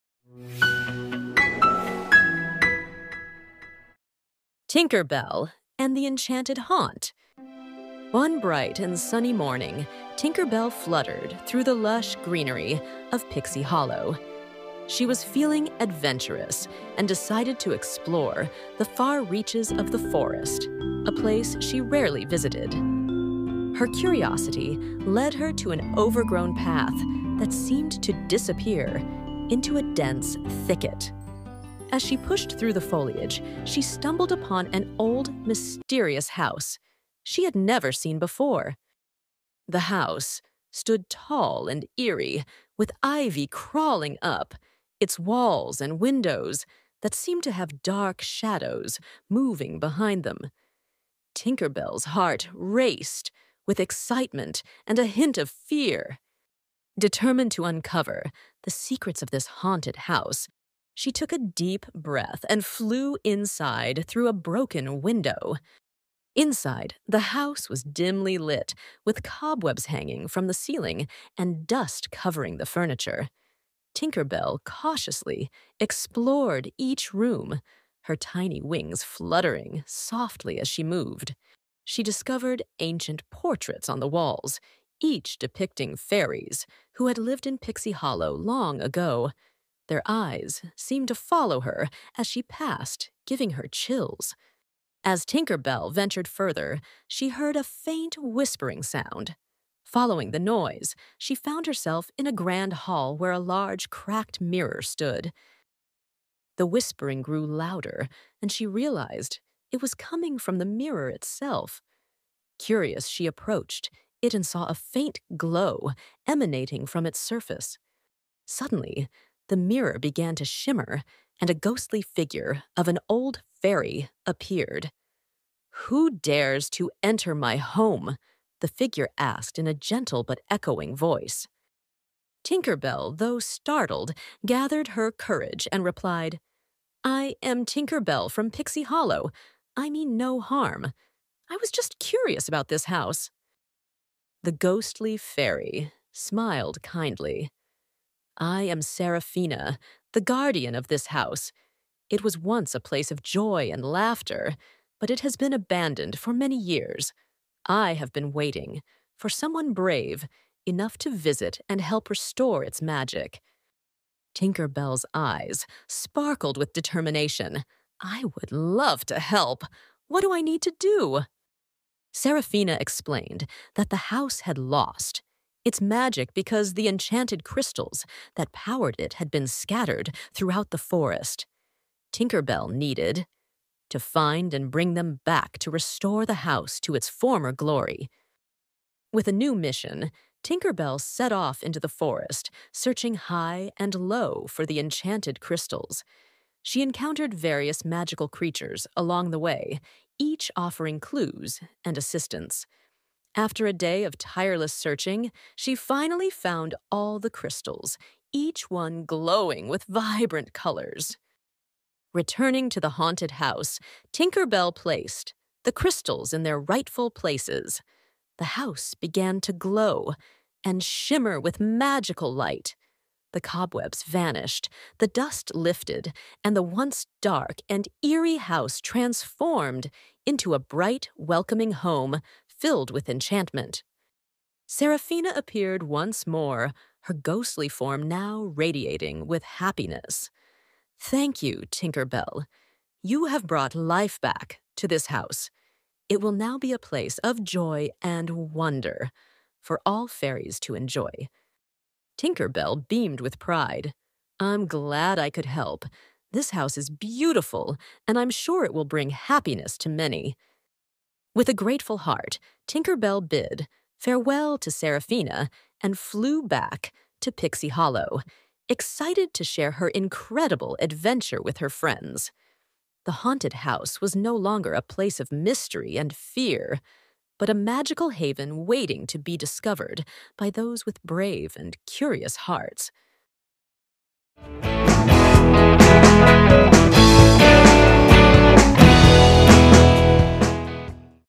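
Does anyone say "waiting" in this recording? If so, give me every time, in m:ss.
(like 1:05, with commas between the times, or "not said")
2:38, 4:38.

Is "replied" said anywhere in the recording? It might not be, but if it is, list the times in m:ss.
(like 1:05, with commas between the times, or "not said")
2:15.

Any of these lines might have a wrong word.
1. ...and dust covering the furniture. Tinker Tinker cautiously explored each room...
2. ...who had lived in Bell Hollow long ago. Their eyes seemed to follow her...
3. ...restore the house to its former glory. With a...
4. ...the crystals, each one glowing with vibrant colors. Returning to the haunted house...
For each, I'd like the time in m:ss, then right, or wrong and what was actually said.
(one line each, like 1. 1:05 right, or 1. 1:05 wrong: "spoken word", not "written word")
1. 1:11 wrong: "Bell", not "Tinker"
2. 1:26 wrong: "Pixie", not "Bell"
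3. 3:05 right
4. 3:27 right.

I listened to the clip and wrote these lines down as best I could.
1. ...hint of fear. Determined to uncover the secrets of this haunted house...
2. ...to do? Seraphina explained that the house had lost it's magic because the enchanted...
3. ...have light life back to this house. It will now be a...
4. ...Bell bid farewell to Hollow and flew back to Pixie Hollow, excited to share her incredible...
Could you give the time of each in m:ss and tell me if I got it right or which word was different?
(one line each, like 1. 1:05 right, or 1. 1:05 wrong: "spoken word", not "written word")
1. 0:55 right
2. 2:50 right
3. 4:03 wrong: "brought", not "light"
4. 4:22 wrong: "Seraphina", not "Hollow".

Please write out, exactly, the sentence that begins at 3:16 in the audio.
She encountered various magical creatures along the way, each offering clues and assistance.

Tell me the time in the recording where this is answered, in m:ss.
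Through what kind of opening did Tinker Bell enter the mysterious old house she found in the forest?
1:04.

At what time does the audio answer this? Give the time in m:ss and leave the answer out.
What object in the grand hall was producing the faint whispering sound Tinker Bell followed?
1:43.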